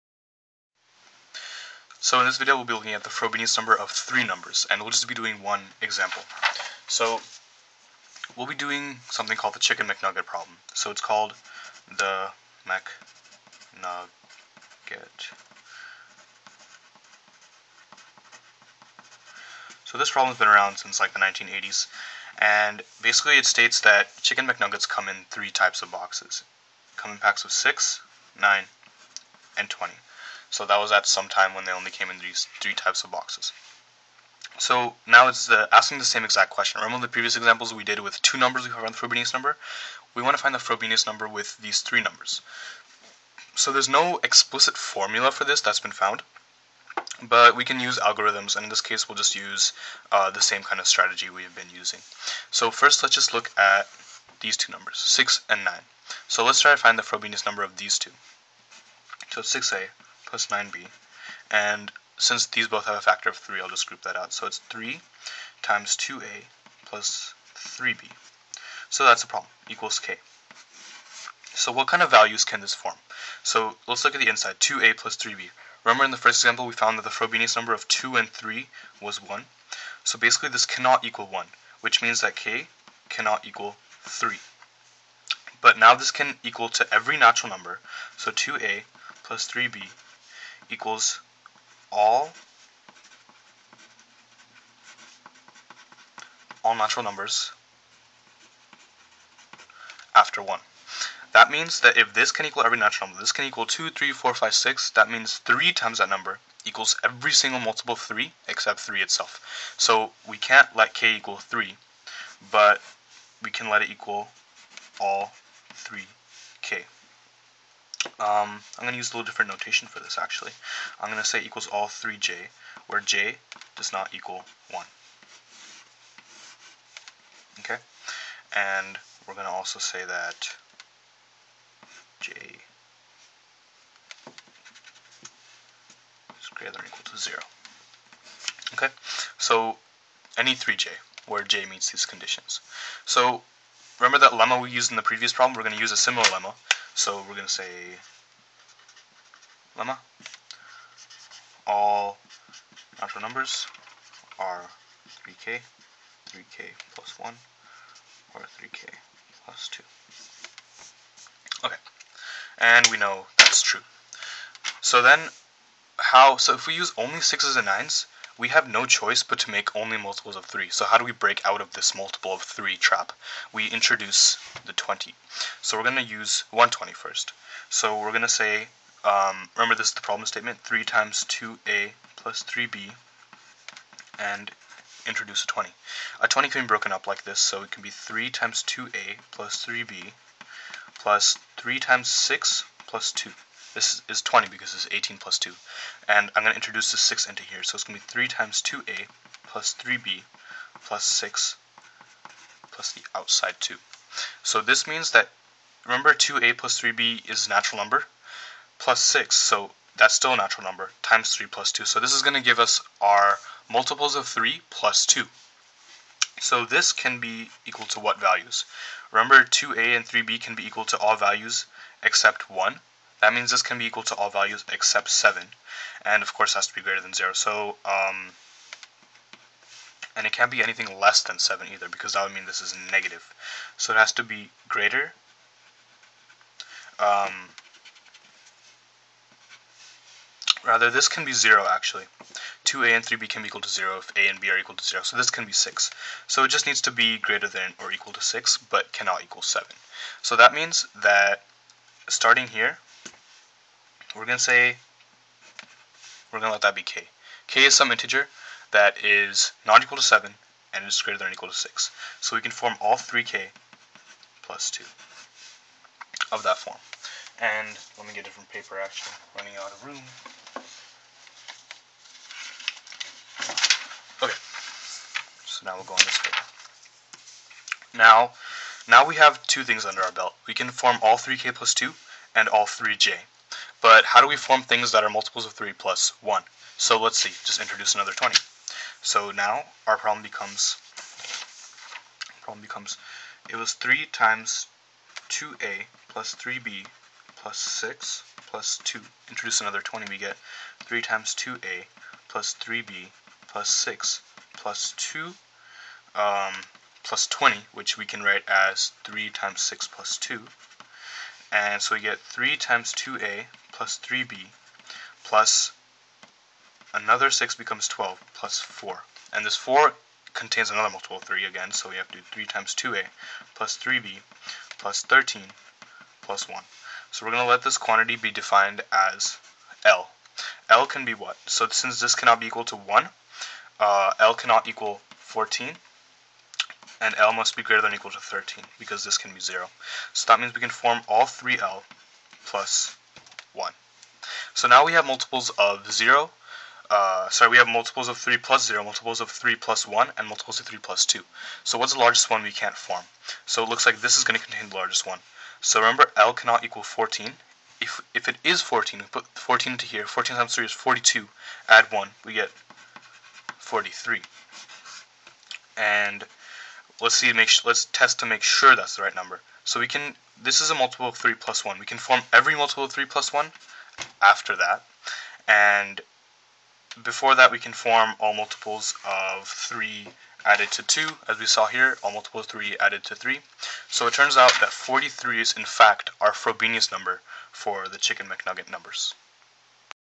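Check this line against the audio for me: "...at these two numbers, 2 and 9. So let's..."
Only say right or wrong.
wrong.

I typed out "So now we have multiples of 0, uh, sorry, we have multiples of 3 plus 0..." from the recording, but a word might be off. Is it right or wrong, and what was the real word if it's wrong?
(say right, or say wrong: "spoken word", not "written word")
right.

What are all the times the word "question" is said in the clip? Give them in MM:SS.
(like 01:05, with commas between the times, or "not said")
00:36.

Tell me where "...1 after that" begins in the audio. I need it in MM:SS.
06:13.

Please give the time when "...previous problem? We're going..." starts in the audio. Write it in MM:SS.
02:25.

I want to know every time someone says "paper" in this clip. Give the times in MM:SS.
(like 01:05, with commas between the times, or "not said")
04:28, 04:36.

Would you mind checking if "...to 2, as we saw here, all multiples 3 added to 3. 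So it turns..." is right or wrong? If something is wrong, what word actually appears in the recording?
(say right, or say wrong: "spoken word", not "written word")
right.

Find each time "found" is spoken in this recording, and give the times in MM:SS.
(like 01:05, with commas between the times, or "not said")
00:38, 00:45, 01:16.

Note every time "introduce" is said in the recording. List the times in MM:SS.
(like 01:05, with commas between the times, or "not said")
02:53, 03:05, 03:16, 04:47, 04:59.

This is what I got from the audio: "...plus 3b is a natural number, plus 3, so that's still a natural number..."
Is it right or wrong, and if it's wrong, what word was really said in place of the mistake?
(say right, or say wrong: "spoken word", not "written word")
wrong: "6", not "3".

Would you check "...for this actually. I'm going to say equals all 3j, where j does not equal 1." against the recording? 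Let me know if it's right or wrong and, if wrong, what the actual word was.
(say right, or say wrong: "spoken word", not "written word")
right.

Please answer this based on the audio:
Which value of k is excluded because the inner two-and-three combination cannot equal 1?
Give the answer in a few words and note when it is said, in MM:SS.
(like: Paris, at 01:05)
3, at 01:22.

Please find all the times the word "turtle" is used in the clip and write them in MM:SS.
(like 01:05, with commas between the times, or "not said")
not said.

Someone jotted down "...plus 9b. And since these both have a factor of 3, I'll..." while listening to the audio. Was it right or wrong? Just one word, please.
right.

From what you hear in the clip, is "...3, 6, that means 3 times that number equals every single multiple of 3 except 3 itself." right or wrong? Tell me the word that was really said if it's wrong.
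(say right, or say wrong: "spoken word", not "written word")
wrong: "5", not "3".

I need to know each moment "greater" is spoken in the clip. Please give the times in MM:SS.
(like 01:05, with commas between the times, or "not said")
02:16, 03:46, 03:54, 04:07, 04:21, 05:37.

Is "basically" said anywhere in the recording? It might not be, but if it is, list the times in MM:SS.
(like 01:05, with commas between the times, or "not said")
00:22, 01:20.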